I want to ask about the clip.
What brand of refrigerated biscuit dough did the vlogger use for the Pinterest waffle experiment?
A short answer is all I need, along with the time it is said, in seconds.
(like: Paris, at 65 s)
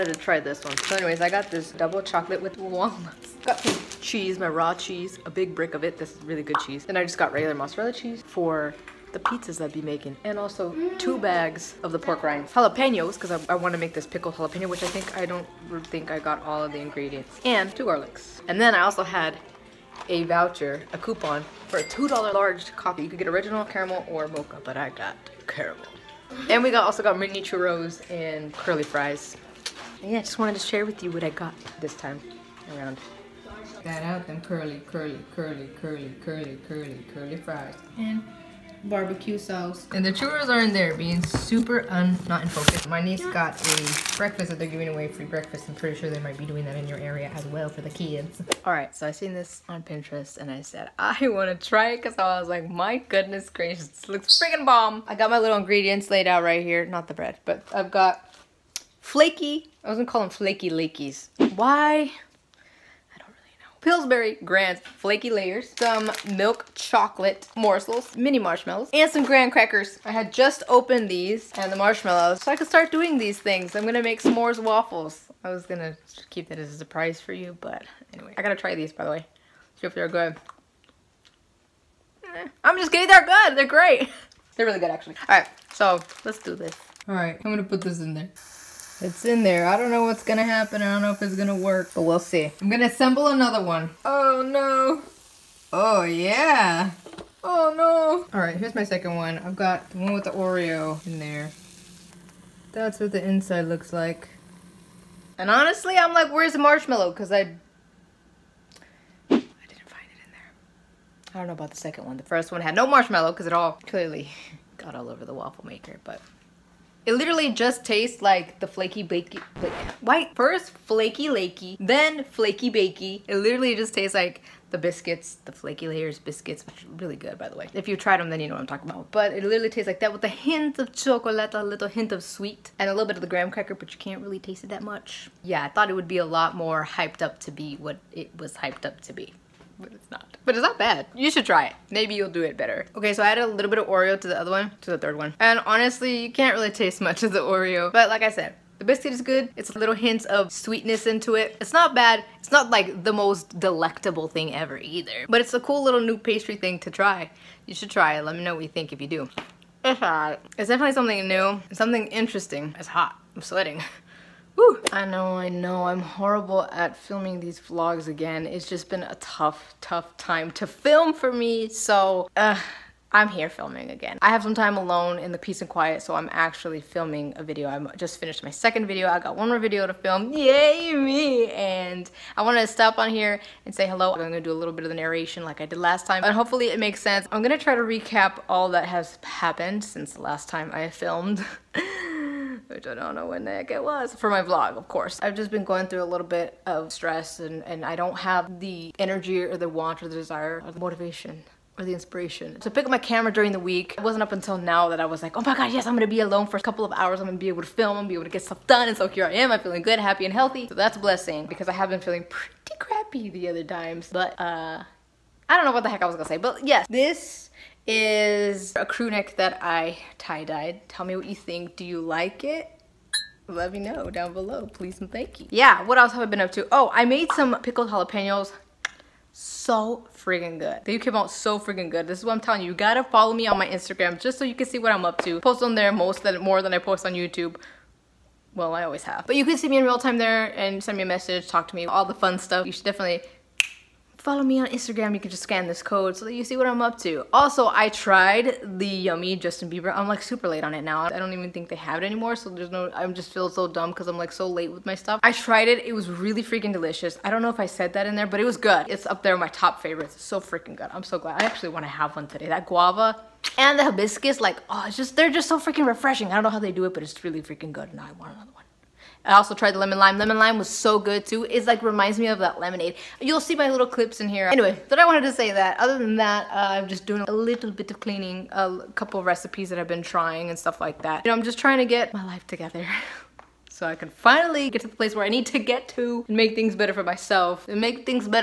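Pillsbury Grand Flaky Layers, at 63 s.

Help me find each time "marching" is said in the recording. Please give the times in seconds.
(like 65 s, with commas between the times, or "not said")
not said.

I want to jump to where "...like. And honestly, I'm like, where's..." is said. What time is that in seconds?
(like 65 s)
103 s.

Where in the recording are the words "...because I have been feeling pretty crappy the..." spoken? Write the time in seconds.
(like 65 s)
211 s.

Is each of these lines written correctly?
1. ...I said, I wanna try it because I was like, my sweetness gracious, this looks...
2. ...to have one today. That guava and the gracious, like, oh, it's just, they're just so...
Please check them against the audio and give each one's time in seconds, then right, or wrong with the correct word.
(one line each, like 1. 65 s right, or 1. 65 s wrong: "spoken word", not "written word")
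1. 50 s wrong: "goodness", not "sweetness"
2. 261 s wrong: "hibiscus", not "gracious".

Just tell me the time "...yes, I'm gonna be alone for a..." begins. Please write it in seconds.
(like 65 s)
205 s.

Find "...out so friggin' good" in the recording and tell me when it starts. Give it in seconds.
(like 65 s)
231 s.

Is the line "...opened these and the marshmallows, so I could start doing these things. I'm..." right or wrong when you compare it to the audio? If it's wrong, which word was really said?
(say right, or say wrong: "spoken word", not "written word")
right.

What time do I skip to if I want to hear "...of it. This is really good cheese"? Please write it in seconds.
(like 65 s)
5 s.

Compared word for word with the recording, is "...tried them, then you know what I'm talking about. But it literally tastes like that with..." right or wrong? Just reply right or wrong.
right.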